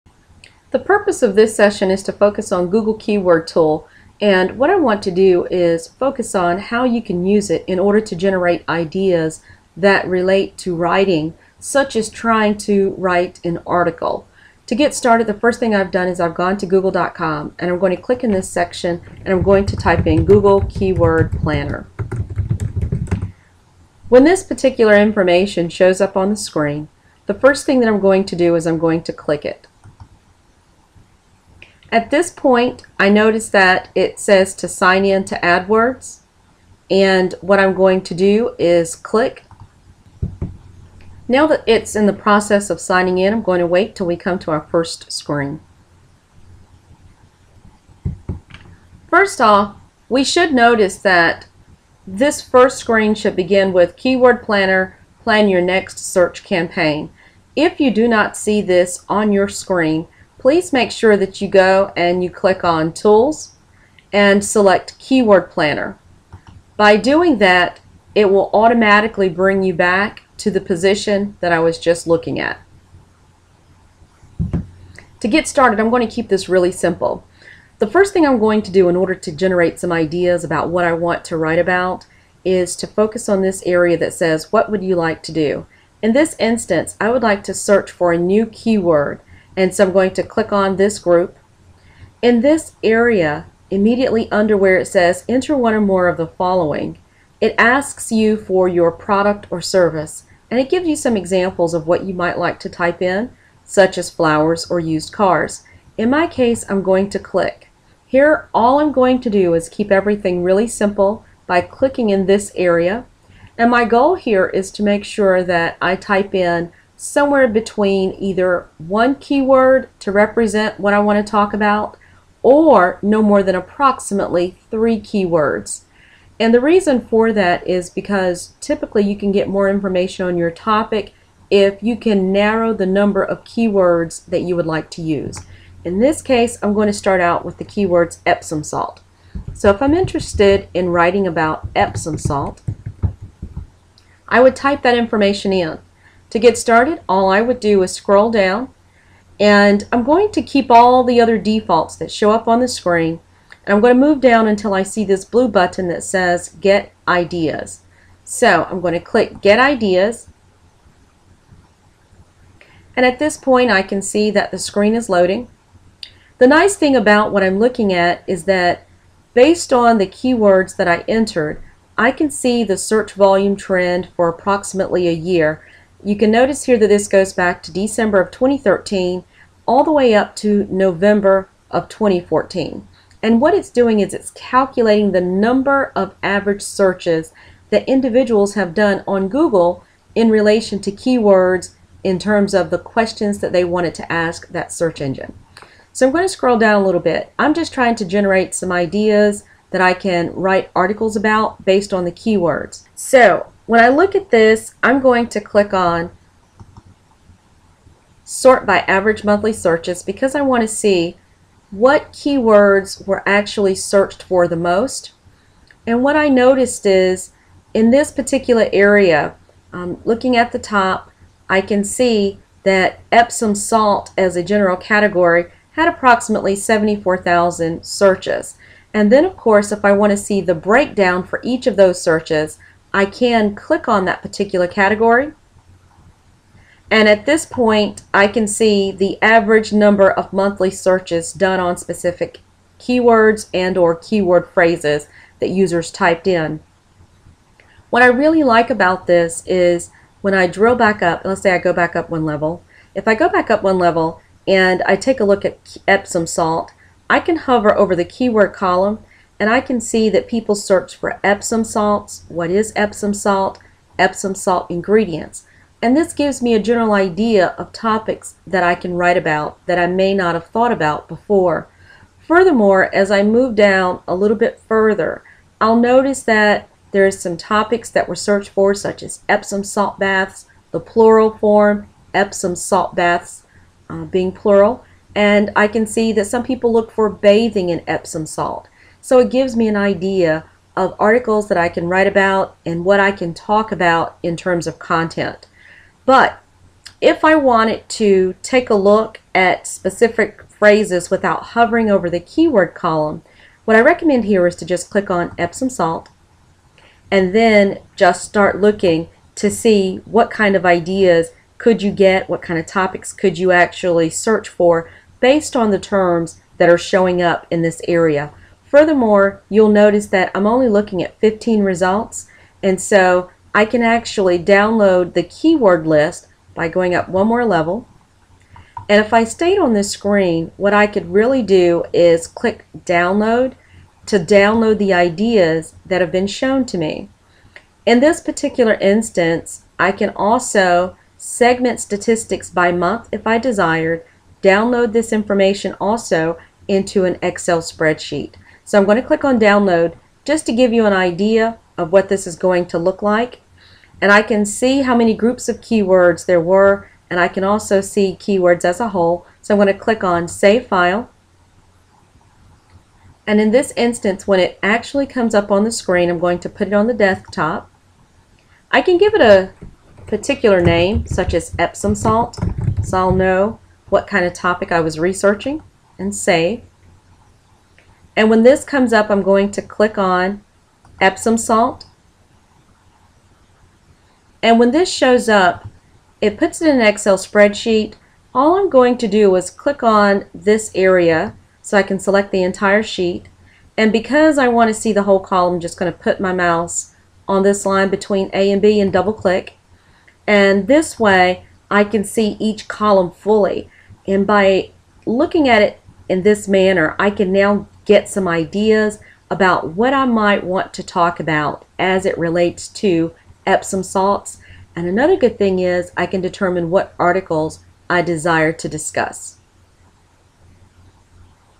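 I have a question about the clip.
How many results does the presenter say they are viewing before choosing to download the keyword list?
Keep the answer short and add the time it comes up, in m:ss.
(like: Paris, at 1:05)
15, at 5:21.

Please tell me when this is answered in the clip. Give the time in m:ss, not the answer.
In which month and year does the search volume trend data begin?
2:57.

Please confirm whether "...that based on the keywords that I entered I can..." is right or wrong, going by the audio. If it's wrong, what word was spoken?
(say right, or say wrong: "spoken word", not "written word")
right.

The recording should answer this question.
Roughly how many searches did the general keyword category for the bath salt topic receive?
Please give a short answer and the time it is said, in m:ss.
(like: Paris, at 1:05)
74,000, at 3:46.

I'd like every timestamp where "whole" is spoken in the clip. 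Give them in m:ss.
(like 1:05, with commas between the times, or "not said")
5:58, 6:35.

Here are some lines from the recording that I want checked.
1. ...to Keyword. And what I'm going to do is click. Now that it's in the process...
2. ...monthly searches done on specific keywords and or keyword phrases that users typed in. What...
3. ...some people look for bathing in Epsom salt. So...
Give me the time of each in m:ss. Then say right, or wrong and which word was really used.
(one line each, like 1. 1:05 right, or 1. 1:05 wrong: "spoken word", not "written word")
1. 0:35 wrong: "AdWords", not "Keyword"
2. 4:00 right
3. 4:46 right.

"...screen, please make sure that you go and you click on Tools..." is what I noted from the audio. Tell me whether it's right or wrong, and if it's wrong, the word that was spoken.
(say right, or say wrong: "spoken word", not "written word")
right.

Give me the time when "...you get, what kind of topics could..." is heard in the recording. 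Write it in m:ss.
5:11.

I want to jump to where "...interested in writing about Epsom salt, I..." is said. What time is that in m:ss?
2:19.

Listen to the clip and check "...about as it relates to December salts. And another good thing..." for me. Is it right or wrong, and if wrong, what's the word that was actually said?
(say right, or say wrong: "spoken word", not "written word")
wrong: "Epsom", not "December".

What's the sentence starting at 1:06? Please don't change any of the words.
By doing that, it will automatically bring you back to the position that I was just looking at.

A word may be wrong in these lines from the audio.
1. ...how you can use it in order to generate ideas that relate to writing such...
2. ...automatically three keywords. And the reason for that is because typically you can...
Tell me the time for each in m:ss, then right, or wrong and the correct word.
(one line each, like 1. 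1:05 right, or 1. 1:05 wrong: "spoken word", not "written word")
1. 0:06 right
2. 2:03 wrong: "approximately", not "automatically".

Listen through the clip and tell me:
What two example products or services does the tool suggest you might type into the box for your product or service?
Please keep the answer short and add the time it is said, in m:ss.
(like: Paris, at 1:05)
flowers or used cars, at 1:44.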